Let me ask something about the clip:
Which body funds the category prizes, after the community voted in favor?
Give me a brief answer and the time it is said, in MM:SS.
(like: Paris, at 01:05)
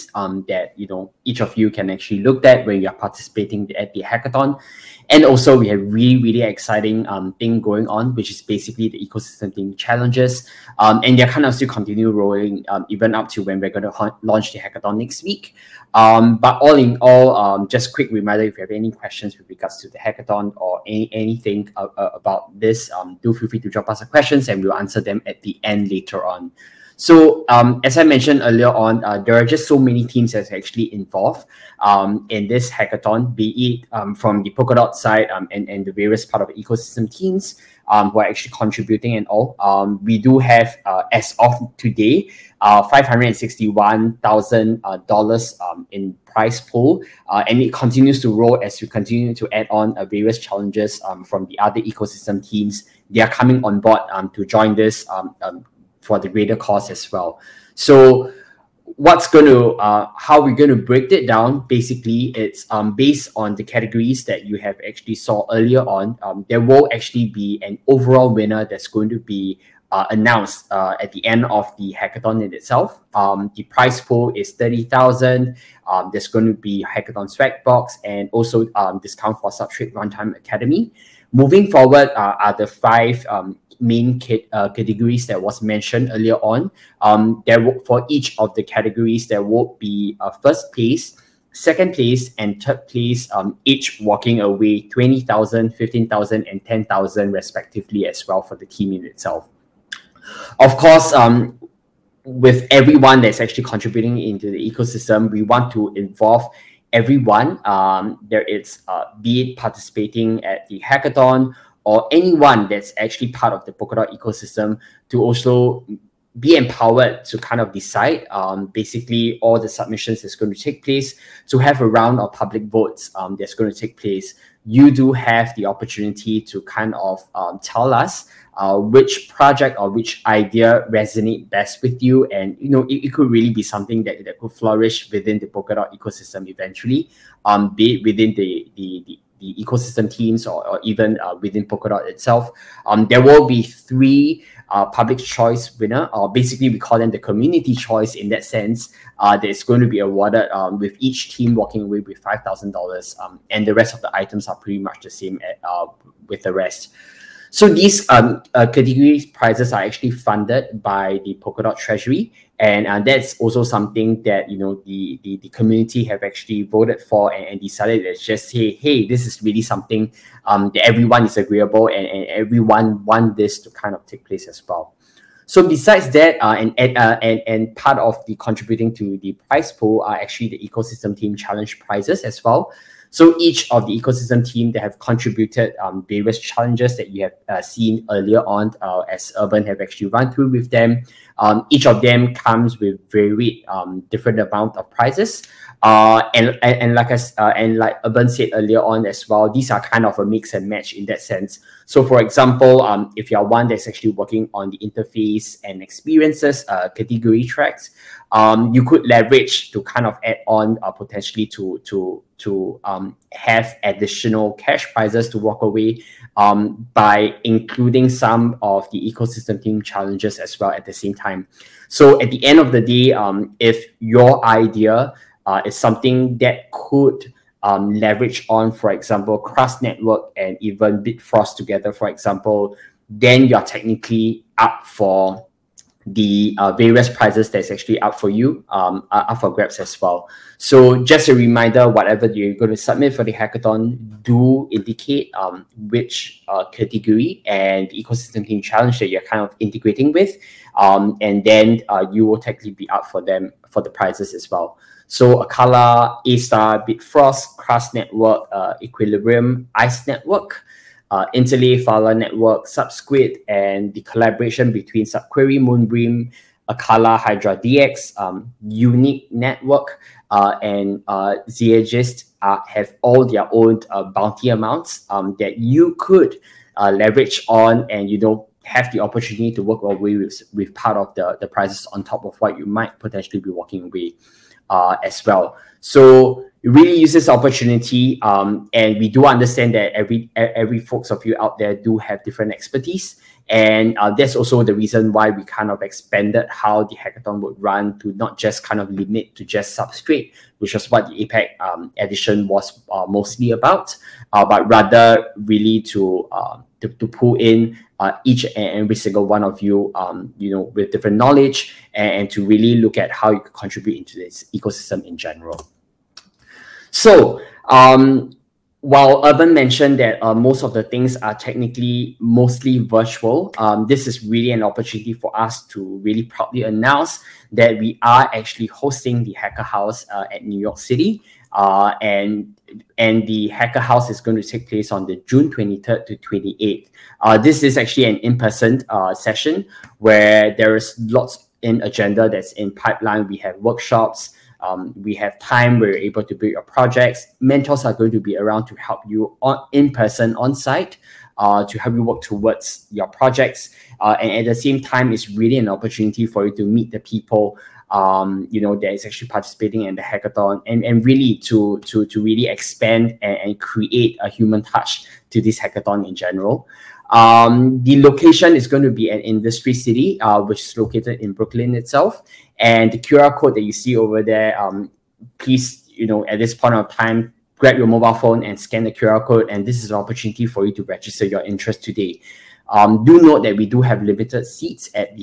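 Polkadot Treasury, at 02:41.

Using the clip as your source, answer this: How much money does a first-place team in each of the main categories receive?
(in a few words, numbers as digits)
20,000.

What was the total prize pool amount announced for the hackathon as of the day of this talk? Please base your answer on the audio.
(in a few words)
$561,000.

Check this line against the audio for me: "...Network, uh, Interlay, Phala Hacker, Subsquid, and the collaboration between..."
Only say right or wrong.
wrong.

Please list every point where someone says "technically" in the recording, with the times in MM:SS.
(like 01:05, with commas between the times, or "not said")
03:53, 04:12, 05:21.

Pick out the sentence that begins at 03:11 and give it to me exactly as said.
Um, each of them comes with very um, different amount of prizes.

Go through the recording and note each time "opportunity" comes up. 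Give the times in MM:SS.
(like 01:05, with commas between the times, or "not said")
02:05, 04:38, 04:47, 05:24, 05:55, 06:19.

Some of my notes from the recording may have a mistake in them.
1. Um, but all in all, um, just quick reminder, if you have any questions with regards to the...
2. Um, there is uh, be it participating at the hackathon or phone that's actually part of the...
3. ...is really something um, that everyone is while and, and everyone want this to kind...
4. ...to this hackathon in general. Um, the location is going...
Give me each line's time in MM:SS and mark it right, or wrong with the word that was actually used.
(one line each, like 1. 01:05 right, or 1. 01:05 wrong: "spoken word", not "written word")
1. 00:15 right
2. 01:47 wrong: "anyone", not "phone"
3. 02:49 wrong: "agreeable", not "while"
4. 06:05 right.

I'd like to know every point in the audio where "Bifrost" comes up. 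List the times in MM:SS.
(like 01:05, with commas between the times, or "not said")
03:51, 04:16.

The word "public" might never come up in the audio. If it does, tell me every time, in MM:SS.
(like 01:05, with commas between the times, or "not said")
02:02, 02:24.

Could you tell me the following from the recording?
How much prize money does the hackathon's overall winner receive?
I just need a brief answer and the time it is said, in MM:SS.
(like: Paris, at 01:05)
30000, at 01:14.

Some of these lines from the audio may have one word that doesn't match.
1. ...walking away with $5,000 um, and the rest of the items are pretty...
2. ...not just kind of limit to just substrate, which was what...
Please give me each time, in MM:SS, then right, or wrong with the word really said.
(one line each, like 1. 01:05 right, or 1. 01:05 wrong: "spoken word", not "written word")
1. 02:31 right
2. 04:58 right.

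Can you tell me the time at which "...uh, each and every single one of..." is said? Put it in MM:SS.
05:07.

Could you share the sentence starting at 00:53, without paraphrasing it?
They are coming on board to join this for the greater cause as well.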